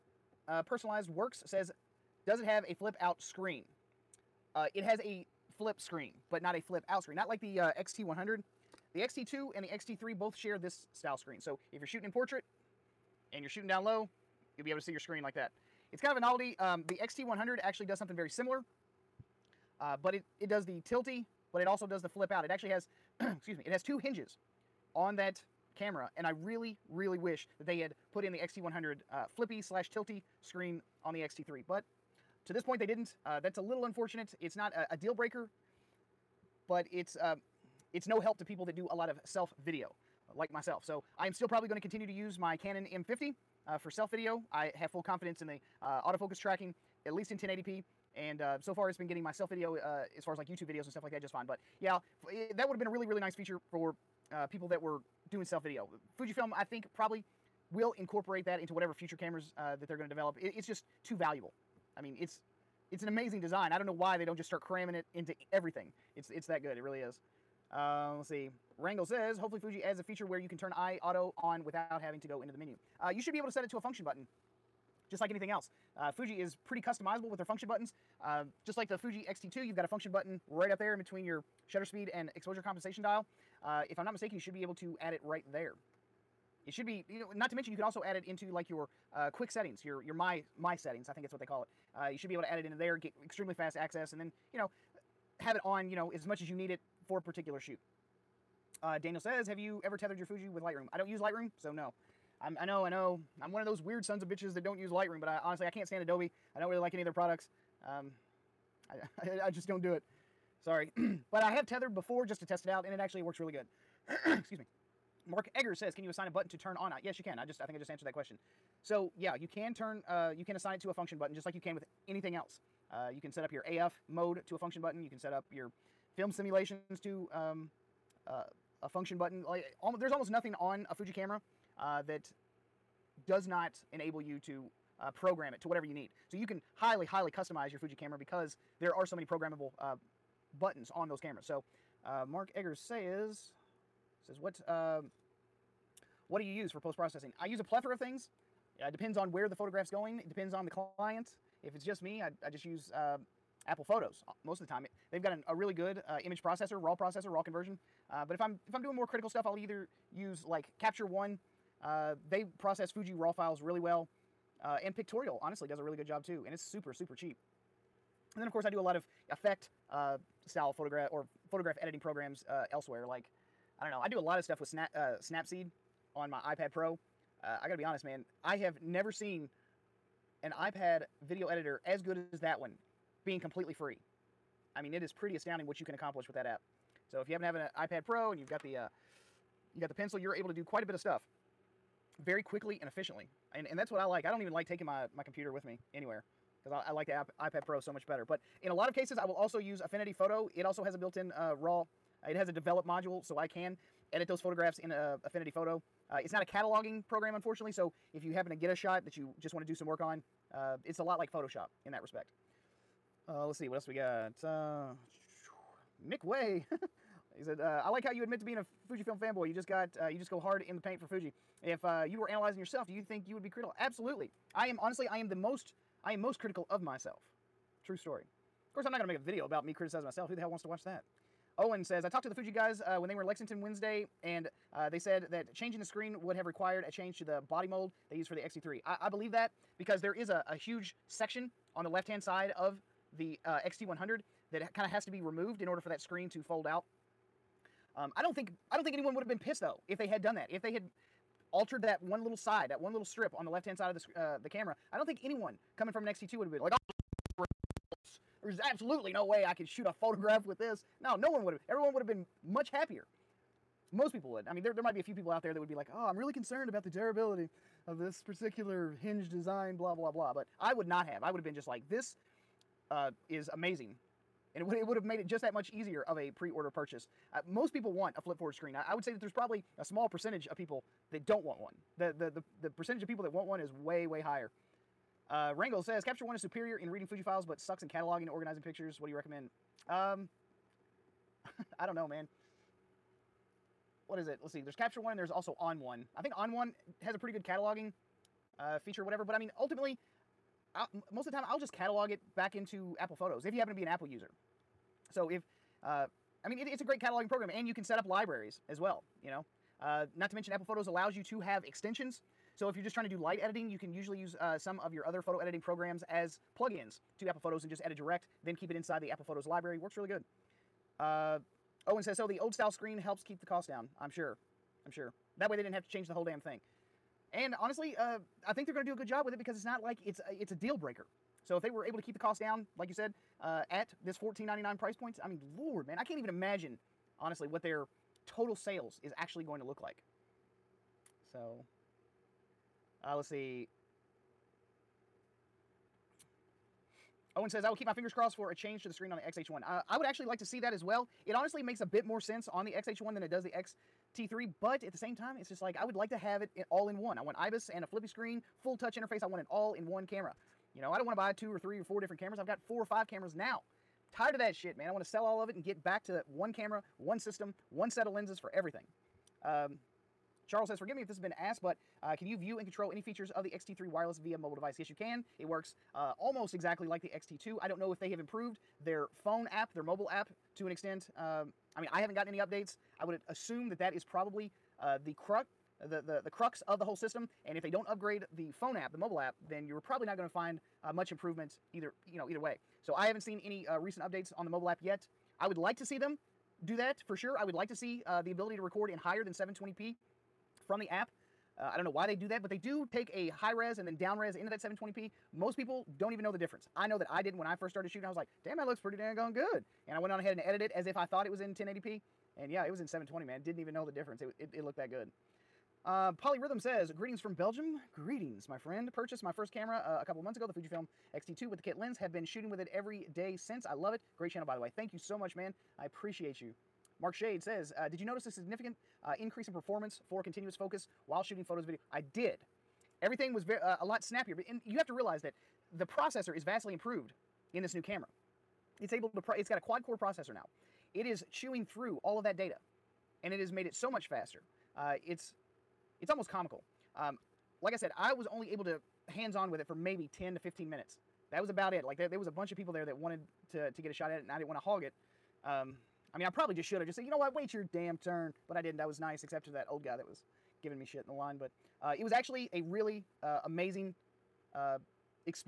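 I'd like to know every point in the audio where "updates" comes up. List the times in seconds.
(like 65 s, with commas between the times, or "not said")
382 s, 394 s.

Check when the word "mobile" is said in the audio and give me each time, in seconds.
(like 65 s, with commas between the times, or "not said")
374 s, 379 s, 388 s, 394 s.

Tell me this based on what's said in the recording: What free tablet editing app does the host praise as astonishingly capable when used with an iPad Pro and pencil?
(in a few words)
Snapseed.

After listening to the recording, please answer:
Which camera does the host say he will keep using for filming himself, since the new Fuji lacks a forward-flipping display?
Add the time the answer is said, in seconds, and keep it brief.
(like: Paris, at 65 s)
Canon M50, at 42 s.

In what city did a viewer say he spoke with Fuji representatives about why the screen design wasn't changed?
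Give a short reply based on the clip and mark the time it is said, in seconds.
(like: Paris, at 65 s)
Lexington, at 233 s.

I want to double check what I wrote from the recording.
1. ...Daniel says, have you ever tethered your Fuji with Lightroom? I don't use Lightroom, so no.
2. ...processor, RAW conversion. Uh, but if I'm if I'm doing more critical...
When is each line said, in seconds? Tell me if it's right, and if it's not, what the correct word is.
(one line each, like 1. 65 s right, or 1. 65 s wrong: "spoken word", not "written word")
1. 98 s right
2. 156 s right.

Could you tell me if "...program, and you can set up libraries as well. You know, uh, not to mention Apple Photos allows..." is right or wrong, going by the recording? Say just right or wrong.
right.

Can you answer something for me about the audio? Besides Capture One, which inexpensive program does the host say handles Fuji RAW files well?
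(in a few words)
Pictorial.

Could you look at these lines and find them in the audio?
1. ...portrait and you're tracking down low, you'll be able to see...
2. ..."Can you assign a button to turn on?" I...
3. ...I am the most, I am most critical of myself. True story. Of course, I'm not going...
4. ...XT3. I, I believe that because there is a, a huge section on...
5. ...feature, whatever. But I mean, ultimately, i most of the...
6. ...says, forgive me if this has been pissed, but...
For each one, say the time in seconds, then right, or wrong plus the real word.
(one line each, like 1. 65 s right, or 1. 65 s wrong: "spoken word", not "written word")
1. 12 s wrong: "shooting", not "tracking"
2. 115 s right
3. 225 s right
4. 238 s right
5. 298 s right
6. 370 s wrong: "asked", not "pissed".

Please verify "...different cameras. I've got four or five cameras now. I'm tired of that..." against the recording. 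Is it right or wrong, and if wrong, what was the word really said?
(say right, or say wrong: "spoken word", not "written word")
right.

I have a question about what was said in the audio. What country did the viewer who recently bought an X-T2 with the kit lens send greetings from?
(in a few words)
Belgium.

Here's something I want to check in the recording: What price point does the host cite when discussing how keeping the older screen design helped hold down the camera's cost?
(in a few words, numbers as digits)
$1,499.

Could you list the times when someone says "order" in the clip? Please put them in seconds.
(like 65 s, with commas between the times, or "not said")
245 s, 276 s.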